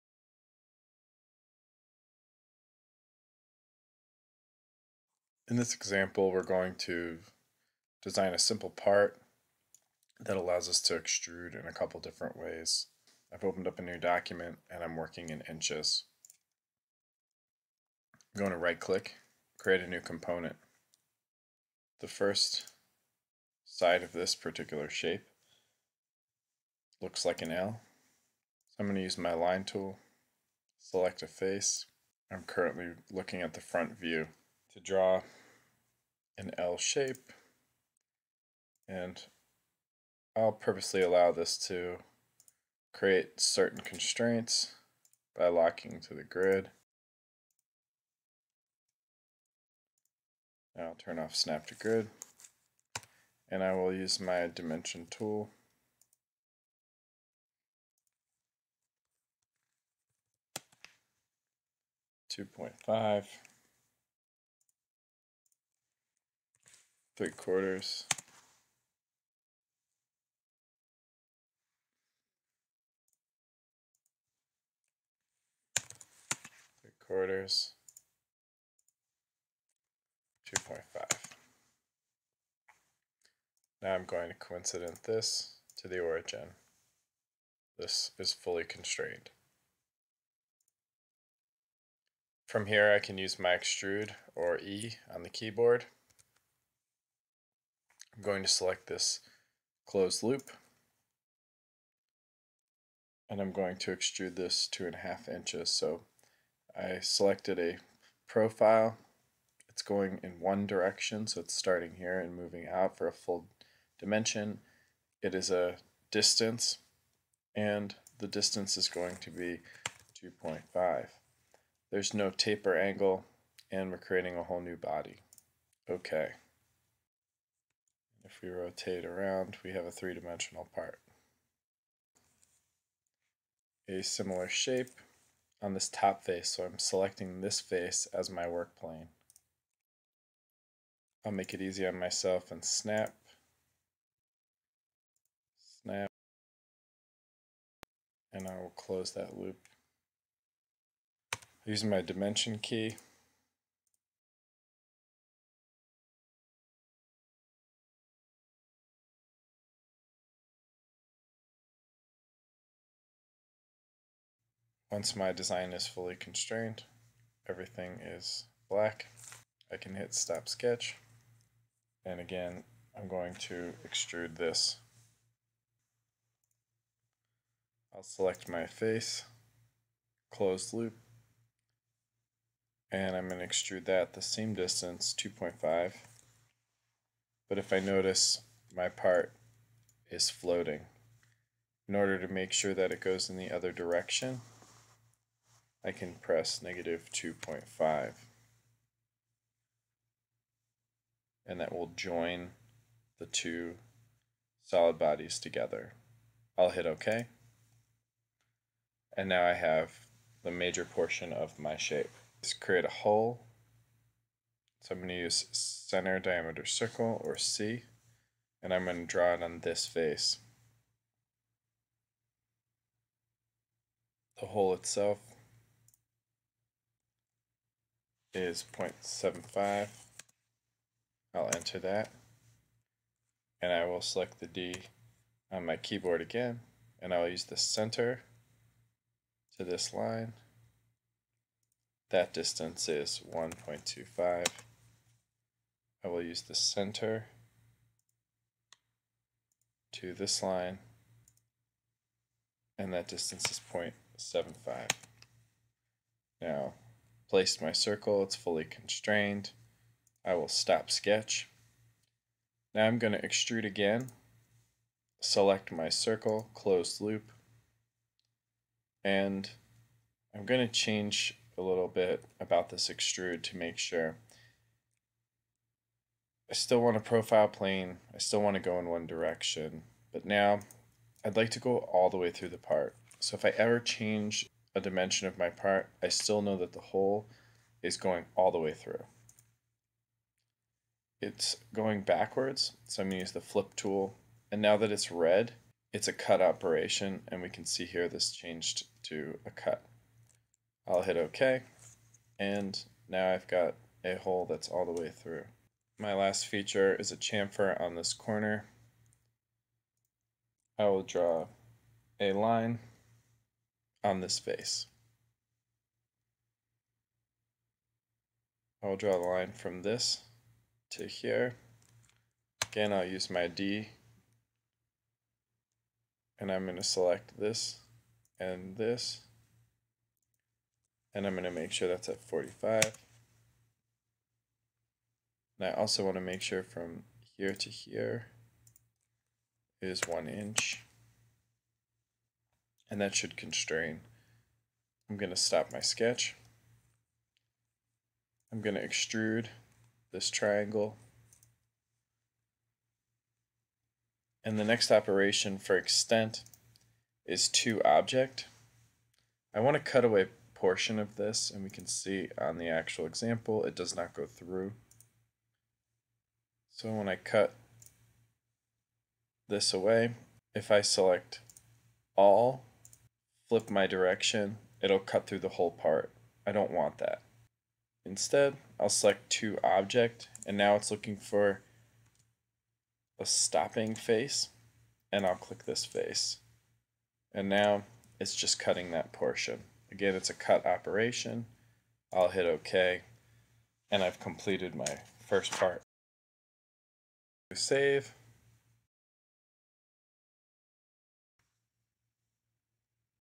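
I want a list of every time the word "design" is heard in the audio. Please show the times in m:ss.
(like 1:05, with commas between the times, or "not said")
0:08, 2:45.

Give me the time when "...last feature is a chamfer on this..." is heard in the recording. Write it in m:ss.
5:06.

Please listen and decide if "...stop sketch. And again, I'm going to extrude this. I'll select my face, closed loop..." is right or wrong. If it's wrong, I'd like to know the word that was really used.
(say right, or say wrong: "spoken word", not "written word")
right.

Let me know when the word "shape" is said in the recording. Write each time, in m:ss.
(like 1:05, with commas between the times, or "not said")
0:24, 0:36, 2:14, 3:31.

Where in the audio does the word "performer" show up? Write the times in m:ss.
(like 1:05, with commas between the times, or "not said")
not said.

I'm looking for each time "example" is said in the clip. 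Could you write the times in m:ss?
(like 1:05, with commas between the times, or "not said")
0:05, 6:03.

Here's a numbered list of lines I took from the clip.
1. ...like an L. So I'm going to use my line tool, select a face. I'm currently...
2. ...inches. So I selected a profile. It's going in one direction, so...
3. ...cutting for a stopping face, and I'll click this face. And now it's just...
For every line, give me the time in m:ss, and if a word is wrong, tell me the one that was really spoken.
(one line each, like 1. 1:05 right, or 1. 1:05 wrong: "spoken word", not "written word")
1. 0:27 right
2. 1:45 right
3. 6:20 wrong: "looking", not "cutting".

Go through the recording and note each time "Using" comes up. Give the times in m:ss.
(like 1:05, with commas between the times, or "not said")
2:31.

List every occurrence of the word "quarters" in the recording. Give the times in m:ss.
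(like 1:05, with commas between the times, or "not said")
1:07, 1:17.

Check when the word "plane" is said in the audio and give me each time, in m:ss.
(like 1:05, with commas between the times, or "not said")
2:18, 4:37.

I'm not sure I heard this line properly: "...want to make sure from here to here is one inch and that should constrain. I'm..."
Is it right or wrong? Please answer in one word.
right.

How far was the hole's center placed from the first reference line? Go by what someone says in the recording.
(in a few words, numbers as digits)
1.25.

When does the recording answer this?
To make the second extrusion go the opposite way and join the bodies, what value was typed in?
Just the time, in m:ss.
3:16.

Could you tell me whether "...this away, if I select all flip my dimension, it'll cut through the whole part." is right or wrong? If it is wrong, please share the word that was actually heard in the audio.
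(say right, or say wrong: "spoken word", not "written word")
wrong: "direction", not "dimension".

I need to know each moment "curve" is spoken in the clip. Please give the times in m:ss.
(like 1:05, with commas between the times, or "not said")
not said.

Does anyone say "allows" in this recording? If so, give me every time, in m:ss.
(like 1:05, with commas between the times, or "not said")
0:10, 0:41.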